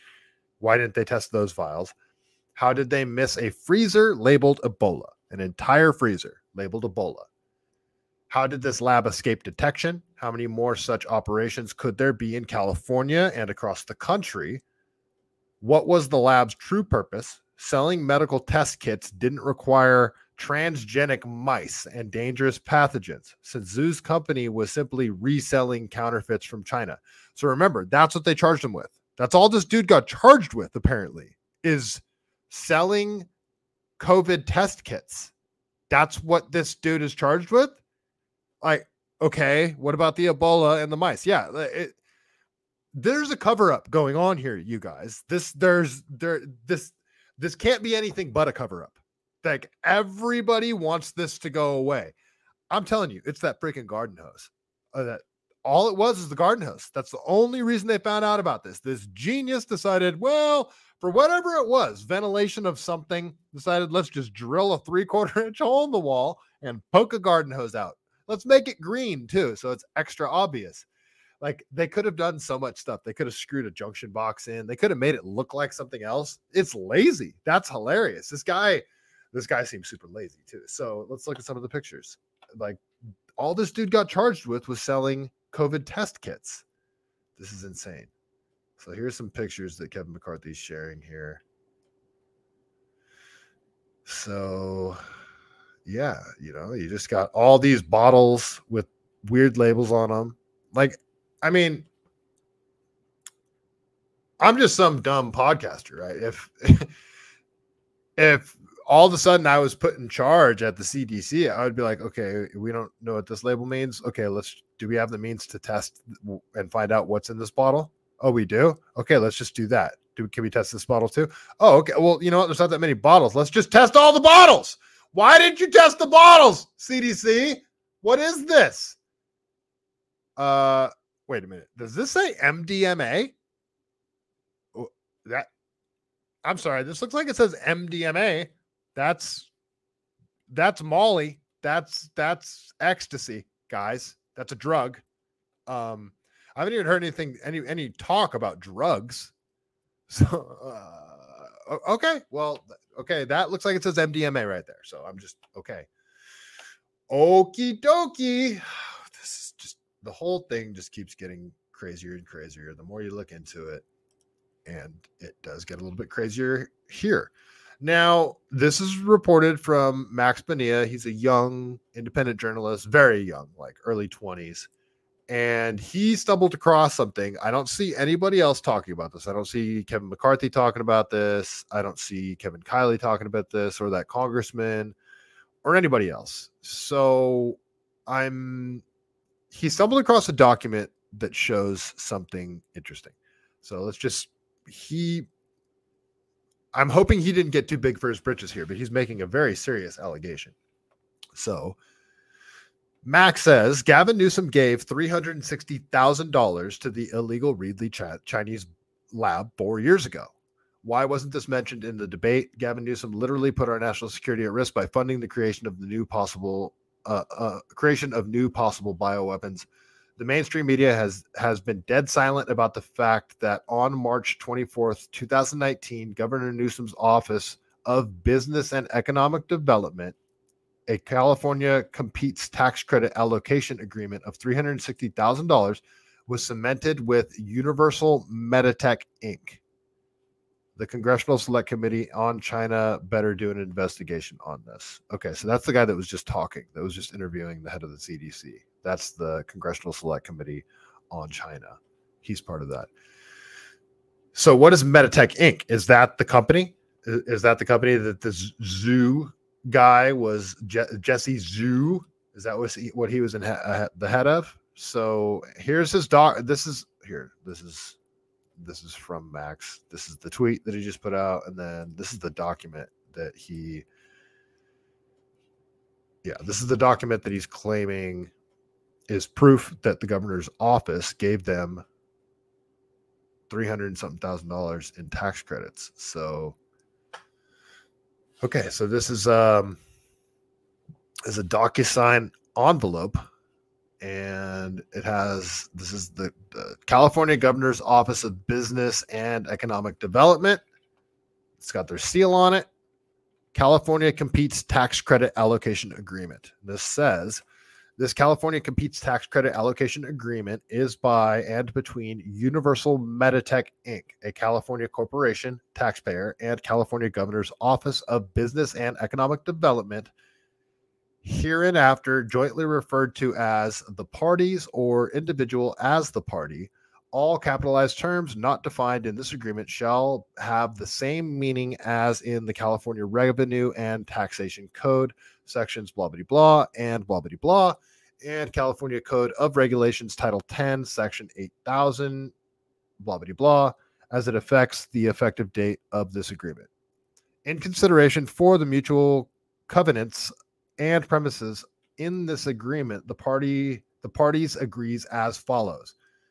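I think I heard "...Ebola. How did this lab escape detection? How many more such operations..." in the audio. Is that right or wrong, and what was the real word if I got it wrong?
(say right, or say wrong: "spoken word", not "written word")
right.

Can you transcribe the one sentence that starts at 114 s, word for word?
Okay, let's do we have the means to test and find out what's in this bottle?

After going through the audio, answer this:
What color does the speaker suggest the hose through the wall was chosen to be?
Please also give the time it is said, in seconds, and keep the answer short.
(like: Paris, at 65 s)
Green, at 68 s.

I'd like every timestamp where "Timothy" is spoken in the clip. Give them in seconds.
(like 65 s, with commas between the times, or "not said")
not said.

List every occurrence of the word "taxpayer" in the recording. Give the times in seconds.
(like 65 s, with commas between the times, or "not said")
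315 s.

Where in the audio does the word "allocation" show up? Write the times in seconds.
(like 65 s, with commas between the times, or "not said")
233 s, 305 s, 309 s.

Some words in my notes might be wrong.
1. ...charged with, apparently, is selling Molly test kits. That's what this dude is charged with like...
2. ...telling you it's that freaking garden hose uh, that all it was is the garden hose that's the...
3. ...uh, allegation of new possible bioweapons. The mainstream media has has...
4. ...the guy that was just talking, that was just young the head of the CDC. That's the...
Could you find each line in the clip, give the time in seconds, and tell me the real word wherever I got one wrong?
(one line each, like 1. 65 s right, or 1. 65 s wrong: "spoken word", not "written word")
1. 30 s wrong: "COVID", not "Molly"
2. 52 s right
3. 217 s wrong: "creation", not "allegation"
4. 245 s wrong: "interviewing", not "young".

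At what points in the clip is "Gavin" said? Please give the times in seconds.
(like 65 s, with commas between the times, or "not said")
203 s, 212 s.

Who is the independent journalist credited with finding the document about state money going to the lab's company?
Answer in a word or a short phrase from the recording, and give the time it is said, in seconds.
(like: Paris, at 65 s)
Max Bonilla, at 170 s.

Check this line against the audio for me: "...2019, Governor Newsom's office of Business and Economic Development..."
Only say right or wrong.
right.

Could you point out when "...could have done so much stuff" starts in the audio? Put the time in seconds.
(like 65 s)
71 s.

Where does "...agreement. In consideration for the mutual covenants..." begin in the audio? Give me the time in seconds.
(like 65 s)
346 s.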